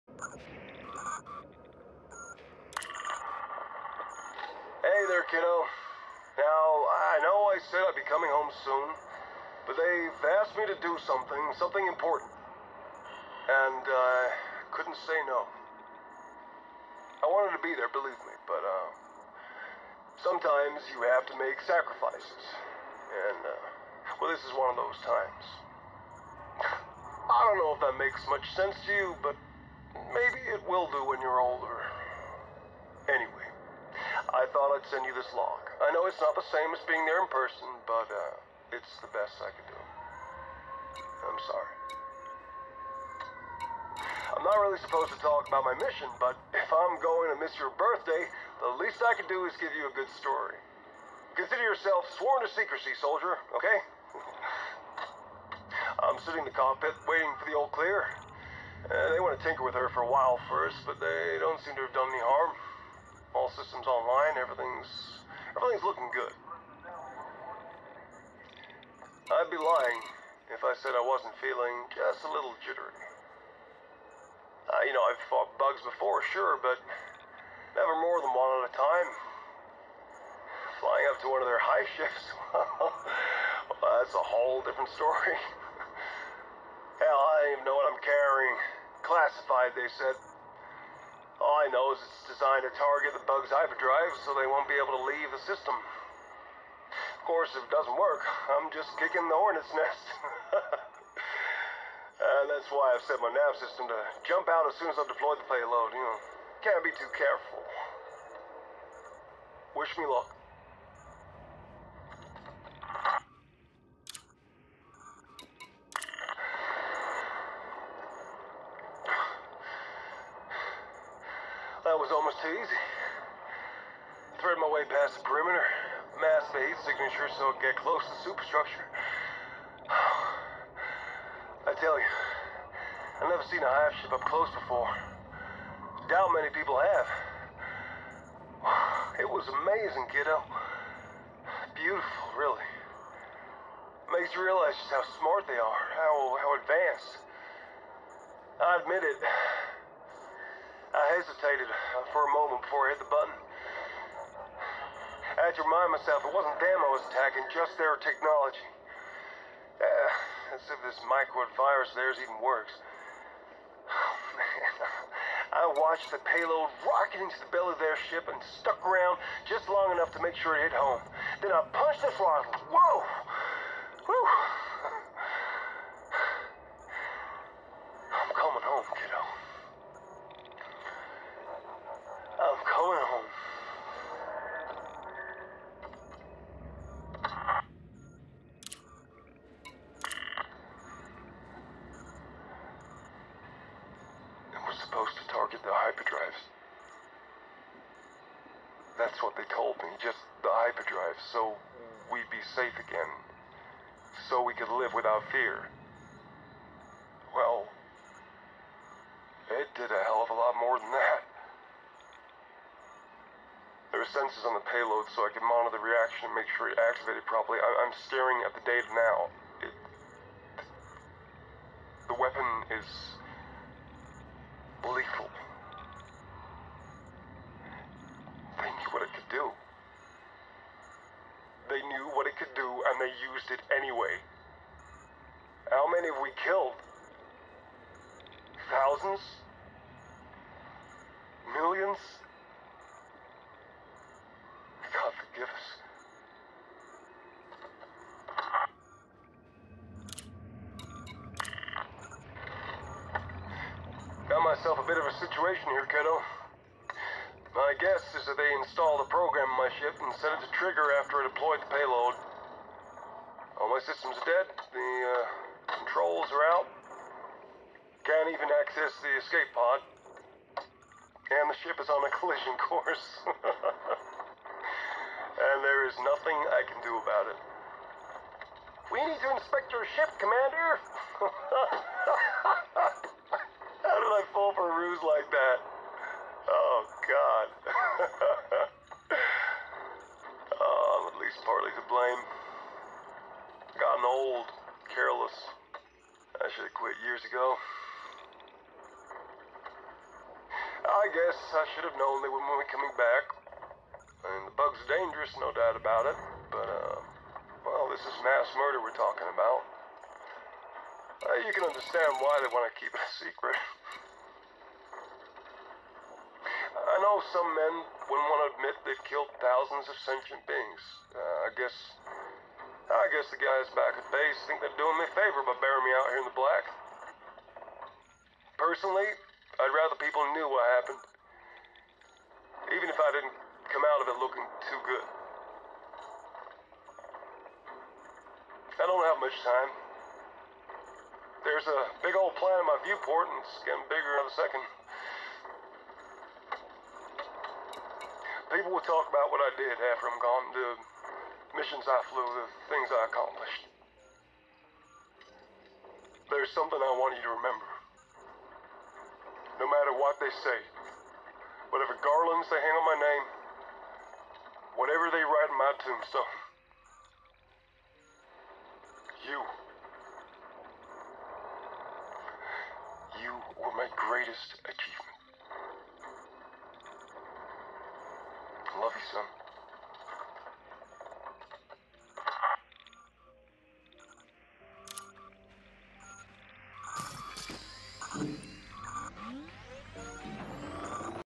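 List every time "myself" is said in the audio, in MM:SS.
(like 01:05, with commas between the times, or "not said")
02:35, 04:14.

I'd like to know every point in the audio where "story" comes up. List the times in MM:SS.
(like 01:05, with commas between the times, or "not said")
00:50, 01:24.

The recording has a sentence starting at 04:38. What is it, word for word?
We need to inspect your ship, Commander.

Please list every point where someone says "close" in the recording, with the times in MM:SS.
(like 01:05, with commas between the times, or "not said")
02:07, 02:14.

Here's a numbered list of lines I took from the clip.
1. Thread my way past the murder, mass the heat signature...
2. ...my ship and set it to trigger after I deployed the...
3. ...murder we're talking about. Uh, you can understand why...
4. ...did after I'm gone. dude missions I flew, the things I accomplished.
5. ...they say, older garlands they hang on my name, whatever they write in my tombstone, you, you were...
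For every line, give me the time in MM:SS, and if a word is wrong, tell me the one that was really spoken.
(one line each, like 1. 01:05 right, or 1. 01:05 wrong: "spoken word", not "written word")
1. 02:04 wrong: "perimeter", not "murder"
2. 04:19 right
3. 05:08 right
4. 05:49 right
5. 06:00 wrong: "whatever", not "older".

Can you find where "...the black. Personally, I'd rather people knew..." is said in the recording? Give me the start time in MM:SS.
05:26.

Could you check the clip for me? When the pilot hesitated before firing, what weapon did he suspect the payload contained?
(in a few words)
micro virus.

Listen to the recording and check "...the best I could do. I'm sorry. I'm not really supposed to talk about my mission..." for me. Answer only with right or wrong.
right.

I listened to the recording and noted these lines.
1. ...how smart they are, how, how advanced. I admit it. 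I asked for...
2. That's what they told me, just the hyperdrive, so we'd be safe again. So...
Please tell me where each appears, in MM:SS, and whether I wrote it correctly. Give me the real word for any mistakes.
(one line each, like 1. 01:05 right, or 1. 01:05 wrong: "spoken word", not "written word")
1. 02:24 wrong: "hesitated", not "asked"
2. 03:18 right.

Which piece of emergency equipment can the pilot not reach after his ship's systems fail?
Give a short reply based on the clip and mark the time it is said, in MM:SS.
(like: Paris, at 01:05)
escape pod, at 04:29.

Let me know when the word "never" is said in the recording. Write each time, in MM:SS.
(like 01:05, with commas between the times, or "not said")
01:17, 02:13.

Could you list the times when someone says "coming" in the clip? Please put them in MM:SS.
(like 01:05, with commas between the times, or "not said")
00:08, 05:02.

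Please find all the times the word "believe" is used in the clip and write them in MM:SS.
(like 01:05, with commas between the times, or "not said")
00:17.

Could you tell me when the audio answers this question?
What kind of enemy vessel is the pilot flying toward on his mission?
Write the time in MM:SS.
01:21.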